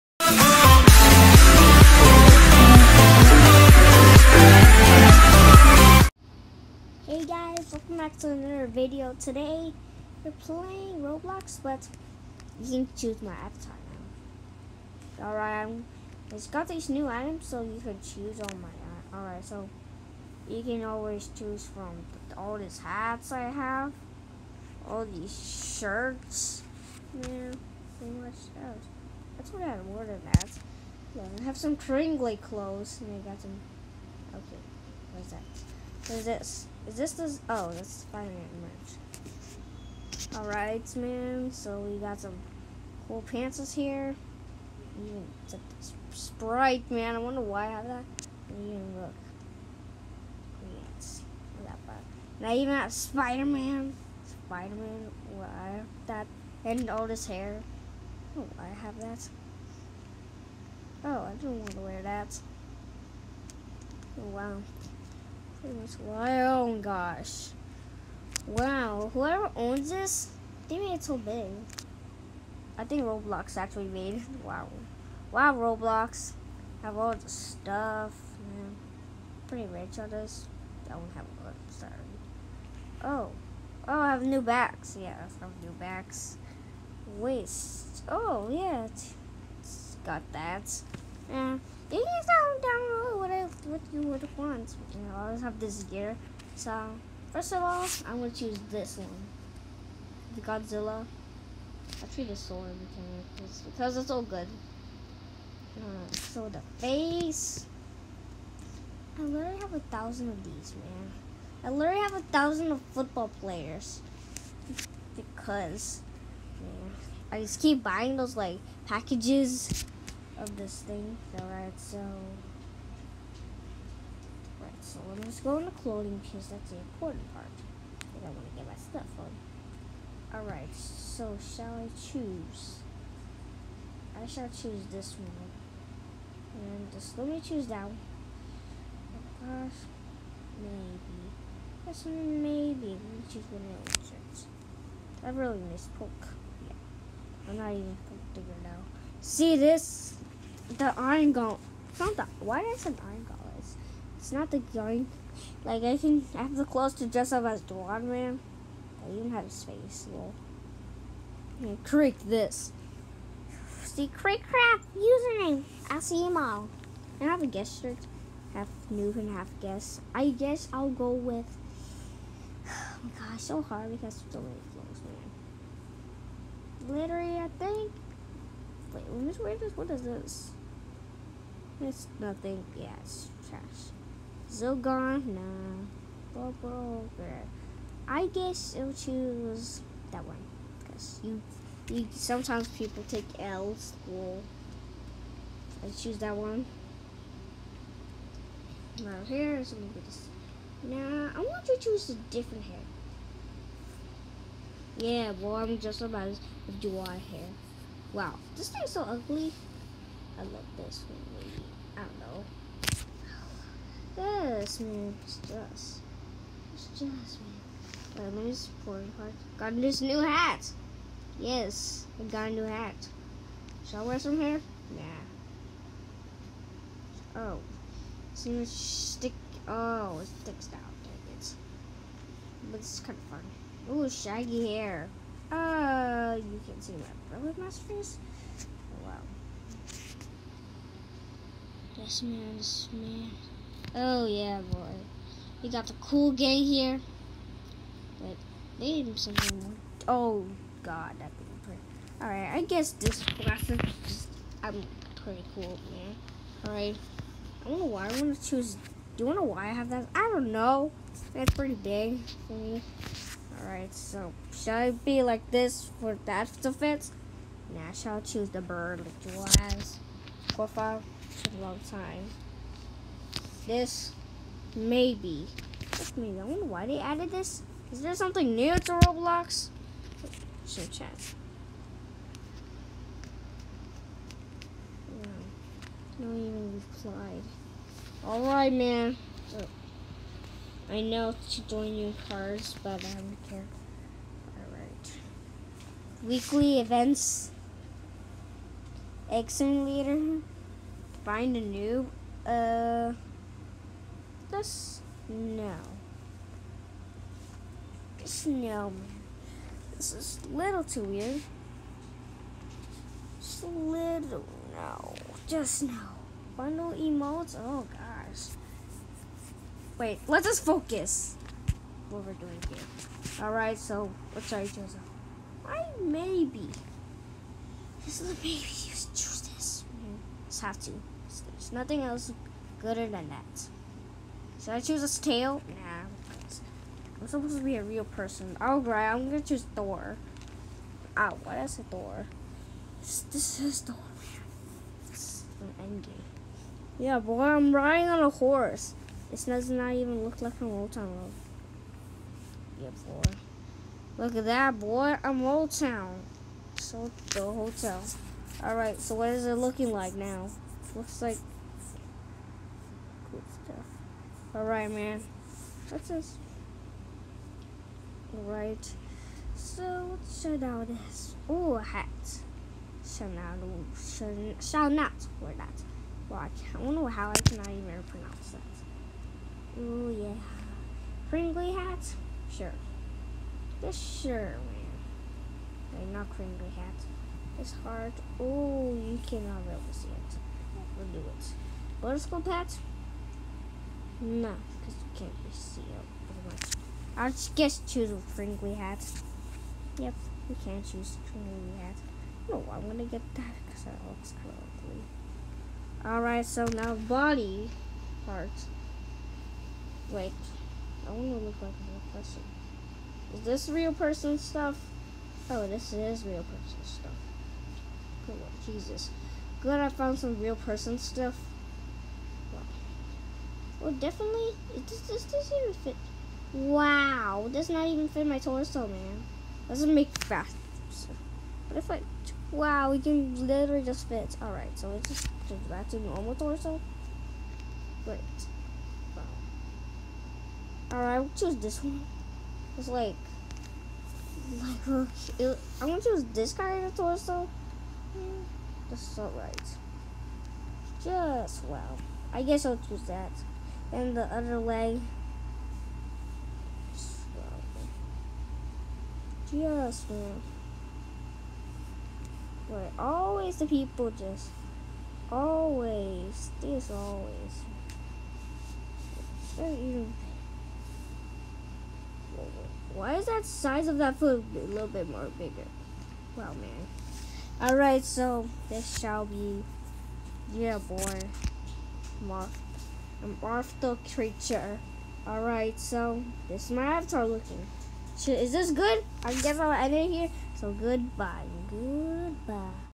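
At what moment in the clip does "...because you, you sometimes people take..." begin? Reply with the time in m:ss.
3:10.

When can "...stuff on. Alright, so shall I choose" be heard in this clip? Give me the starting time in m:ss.
2:08.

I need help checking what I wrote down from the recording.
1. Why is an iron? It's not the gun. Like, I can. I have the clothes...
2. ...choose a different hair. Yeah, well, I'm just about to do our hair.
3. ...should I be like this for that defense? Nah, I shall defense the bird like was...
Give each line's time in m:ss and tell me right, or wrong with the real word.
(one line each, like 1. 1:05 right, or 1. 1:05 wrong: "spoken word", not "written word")
1. 2:32 right
2. 3:21 right
3. 4:24 wrong: "choose", not "defense".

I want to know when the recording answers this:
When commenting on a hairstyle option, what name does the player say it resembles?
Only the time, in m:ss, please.
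3:36.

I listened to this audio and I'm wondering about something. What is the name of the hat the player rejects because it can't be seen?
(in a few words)
Butterscotch hat.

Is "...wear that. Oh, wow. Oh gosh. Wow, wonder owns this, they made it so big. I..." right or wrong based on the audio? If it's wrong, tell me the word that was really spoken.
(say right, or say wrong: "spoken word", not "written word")
wrong: "whoever", not "wonder".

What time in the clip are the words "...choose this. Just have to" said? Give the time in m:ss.
5:28.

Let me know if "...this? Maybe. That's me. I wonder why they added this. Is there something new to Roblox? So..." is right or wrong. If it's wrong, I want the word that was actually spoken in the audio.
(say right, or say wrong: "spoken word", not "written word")
right.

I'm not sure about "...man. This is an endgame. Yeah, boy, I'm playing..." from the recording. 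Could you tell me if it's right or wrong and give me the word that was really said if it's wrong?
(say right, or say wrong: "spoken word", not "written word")
wrong: "riding", not "playing".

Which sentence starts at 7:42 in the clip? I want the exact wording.
always the people just always this always.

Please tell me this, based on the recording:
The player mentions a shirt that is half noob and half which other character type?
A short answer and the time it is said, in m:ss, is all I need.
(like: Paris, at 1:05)
guest, at 2:49.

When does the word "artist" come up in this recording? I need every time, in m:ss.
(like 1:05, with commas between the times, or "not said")
not said.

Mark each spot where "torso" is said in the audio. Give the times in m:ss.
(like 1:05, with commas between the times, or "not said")
7:08, 7:16, 7:26.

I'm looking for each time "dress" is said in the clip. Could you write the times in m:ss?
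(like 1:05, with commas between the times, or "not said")
2:37.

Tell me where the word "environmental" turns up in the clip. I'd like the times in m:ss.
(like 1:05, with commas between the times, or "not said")
not said.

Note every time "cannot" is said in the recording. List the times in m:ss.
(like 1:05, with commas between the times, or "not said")
6:17, 6:29.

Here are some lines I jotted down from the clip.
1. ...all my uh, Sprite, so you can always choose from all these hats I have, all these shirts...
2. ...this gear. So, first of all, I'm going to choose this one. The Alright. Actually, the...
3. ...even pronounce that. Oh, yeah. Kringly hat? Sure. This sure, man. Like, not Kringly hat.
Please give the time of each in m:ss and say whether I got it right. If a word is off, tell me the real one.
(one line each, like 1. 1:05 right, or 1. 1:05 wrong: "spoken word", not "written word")
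1. 0:18 wrong: "Alright", not "Sprite"
2. 1:35 wrong: "Godzilla", not "Alright"
3. 6:17 right.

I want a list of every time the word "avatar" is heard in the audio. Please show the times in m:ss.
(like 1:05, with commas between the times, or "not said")
0:13, 8:06.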